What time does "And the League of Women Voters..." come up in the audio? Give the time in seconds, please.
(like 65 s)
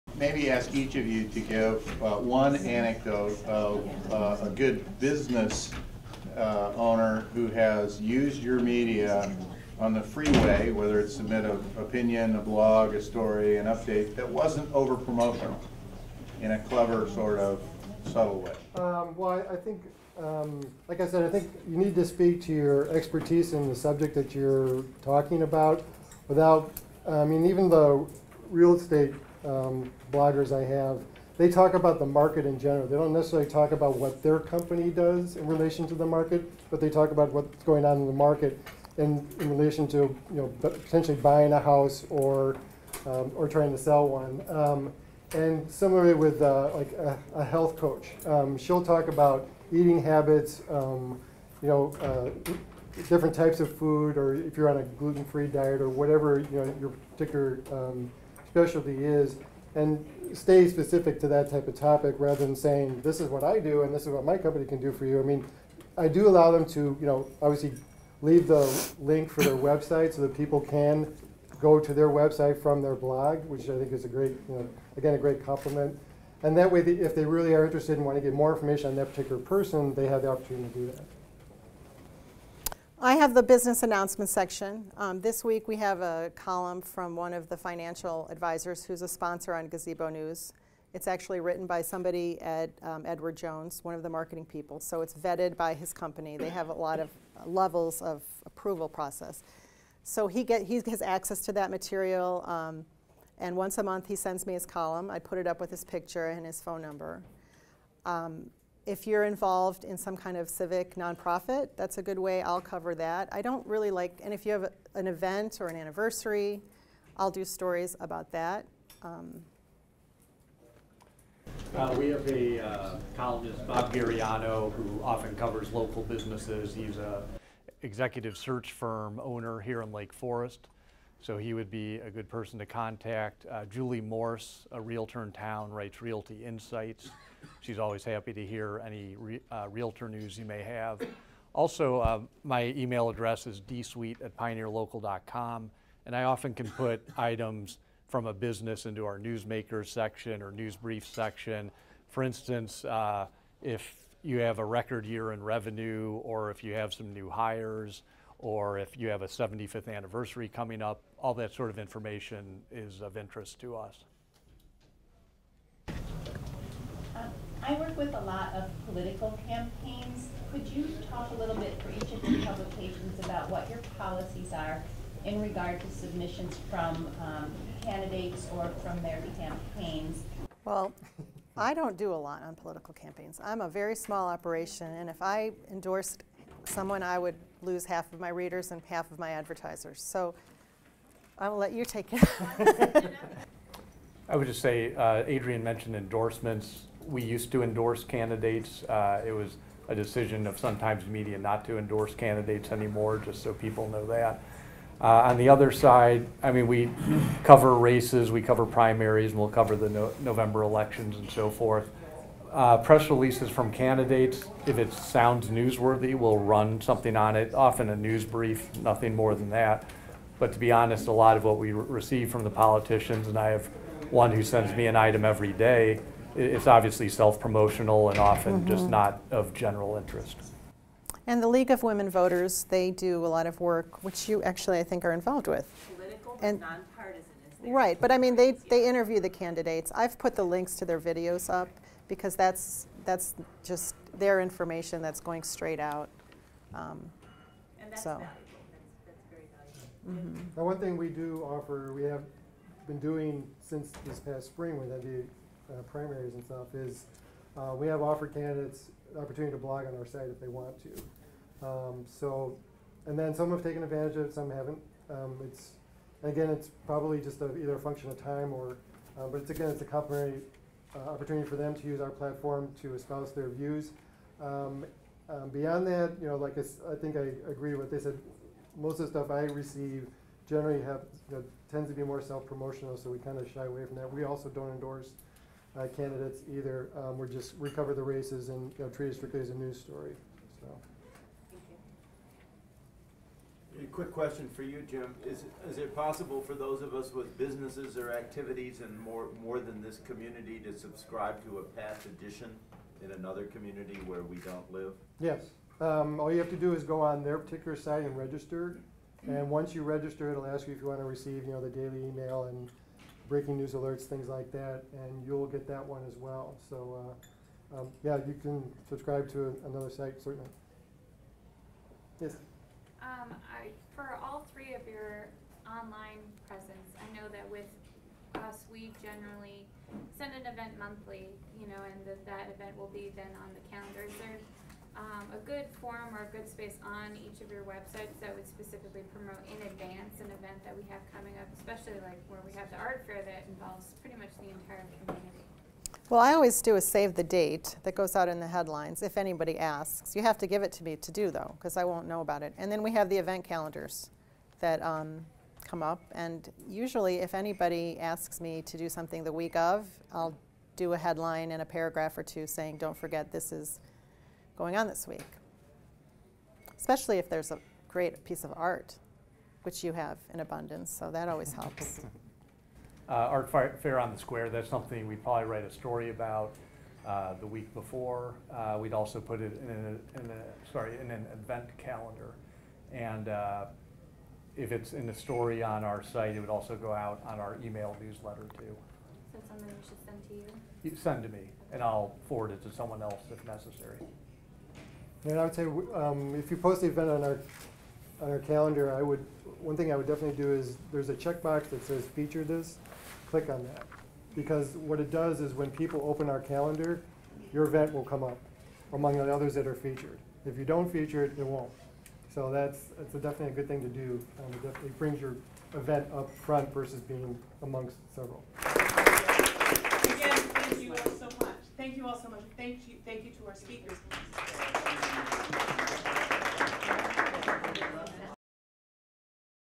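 231 s.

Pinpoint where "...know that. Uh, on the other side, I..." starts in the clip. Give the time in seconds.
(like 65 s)
203 s.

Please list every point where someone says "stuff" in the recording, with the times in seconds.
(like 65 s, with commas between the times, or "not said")
256 s, 279 s.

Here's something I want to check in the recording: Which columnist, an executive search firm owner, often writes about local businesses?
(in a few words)
Bob Gariano.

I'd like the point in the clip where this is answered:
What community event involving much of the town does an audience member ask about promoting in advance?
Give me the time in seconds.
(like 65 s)
373 s.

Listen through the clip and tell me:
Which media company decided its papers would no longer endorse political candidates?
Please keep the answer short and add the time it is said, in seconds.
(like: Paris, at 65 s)
Sun-Times Media, at 200 s.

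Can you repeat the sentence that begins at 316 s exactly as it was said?
So, uh, um, yeah, you can subscribe to another site, certainly.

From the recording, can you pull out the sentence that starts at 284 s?
We also don't endorse uh, candidates either.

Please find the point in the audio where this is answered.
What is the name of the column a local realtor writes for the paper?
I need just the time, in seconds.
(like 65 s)
136 s.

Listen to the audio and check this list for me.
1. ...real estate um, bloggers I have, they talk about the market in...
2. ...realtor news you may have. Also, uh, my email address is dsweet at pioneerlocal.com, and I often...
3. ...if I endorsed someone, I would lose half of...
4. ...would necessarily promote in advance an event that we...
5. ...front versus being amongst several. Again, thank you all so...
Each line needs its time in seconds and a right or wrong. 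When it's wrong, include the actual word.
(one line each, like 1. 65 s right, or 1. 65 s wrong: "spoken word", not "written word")
1. 28 s right
2. 139 s right
3. 185 s right
4. 338 s wrong: "specifically", not "necessarily"
5. 416 s right.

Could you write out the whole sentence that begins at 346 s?
Well, I always do is save the date that goes out in the headlines if anybody asks.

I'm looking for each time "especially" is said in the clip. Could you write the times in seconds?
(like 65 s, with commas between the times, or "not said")
341 s, 366 s.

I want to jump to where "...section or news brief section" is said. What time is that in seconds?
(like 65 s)
149 s.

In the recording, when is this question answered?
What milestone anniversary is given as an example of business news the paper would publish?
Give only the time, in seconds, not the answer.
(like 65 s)
159 s.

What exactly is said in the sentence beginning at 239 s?
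I've put the links to their videos up because that's that's just their information that's going straight out.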